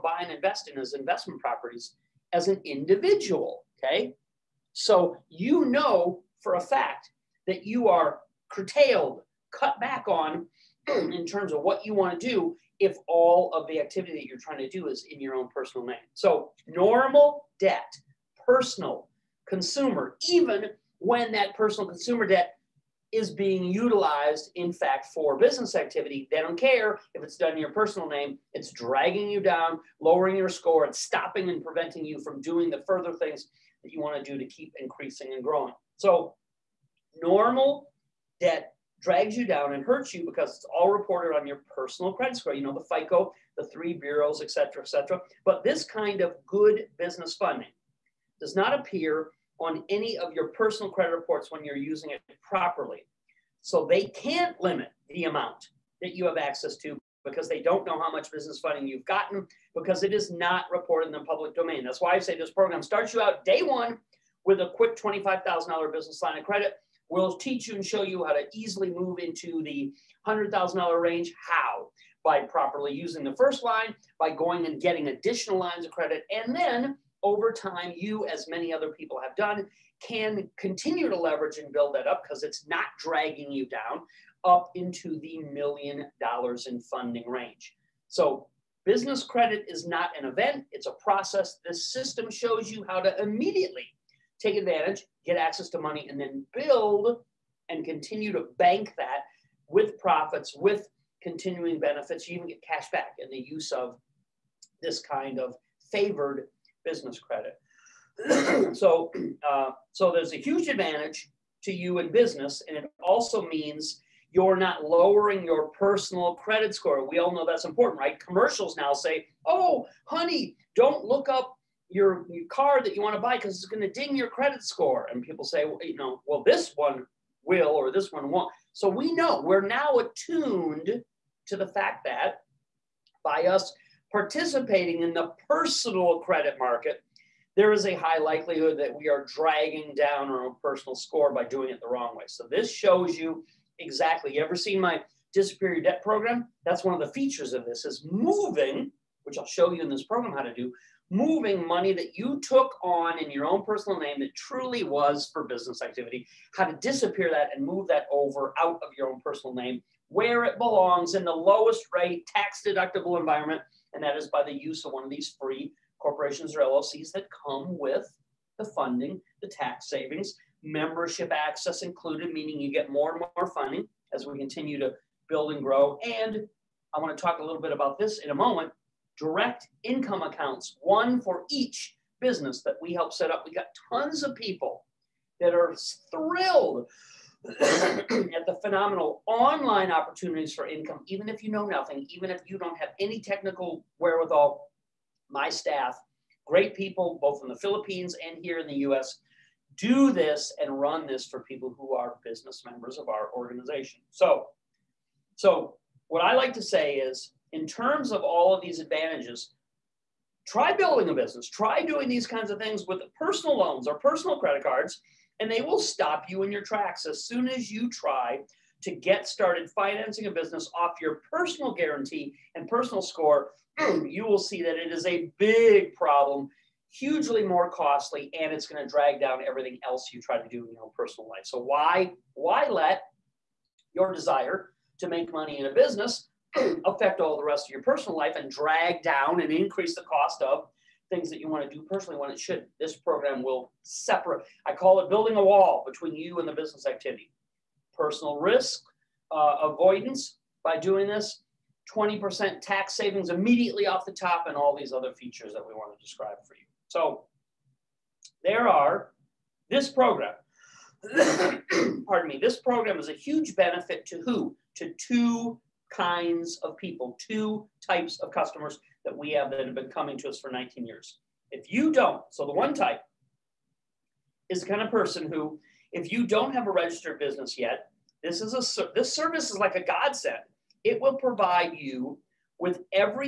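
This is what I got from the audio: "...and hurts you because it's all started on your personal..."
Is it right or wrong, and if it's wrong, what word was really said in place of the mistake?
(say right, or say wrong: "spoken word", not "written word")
wrong: "reported", not "started".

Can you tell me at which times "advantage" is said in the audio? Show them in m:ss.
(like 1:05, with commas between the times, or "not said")
1:34, 1:50, 3:28.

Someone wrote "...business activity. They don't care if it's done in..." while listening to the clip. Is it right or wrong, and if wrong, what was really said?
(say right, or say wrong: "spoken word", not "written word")
right.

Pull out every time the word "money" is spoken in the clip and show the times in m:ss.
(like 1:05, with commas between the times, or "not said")
1:35, 2:31, 3:55.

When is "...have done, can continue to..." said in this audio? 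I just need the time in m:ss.
1:19.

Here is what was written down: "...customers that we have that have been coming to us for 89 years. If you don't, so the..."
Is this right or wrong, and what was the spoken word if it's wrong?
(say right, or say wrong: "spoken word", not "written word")
wrong: "19", not "89".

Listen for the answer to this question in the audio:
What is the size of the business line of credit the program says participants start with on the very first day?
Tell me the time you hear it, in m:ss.
1:04.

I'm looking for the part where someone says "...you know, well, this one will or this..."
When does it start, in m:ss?
2:05.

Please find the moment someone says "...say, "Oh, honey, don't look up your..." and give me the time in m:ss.
1:58.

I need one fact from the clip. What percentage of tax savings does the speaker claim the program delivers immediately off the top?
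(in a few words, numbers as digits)
20%.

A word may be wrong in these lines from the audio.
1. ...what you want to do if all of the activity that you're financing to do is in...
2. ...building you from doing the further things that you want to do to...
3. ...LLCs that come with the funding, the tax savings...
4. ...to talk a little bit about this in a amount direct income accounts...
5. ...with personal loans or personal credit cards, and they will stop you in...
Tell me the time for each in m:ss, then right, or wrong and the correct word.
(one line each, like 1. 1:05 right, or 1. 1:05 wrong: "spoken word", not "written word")
1. 0:11 wrong: "trying", not "financing"
2. 0:31 wrong: "preventing", not "building"
3. 2:46 right
4. 2:57 wrong: "moment", not "amount"
5. 3:32 right.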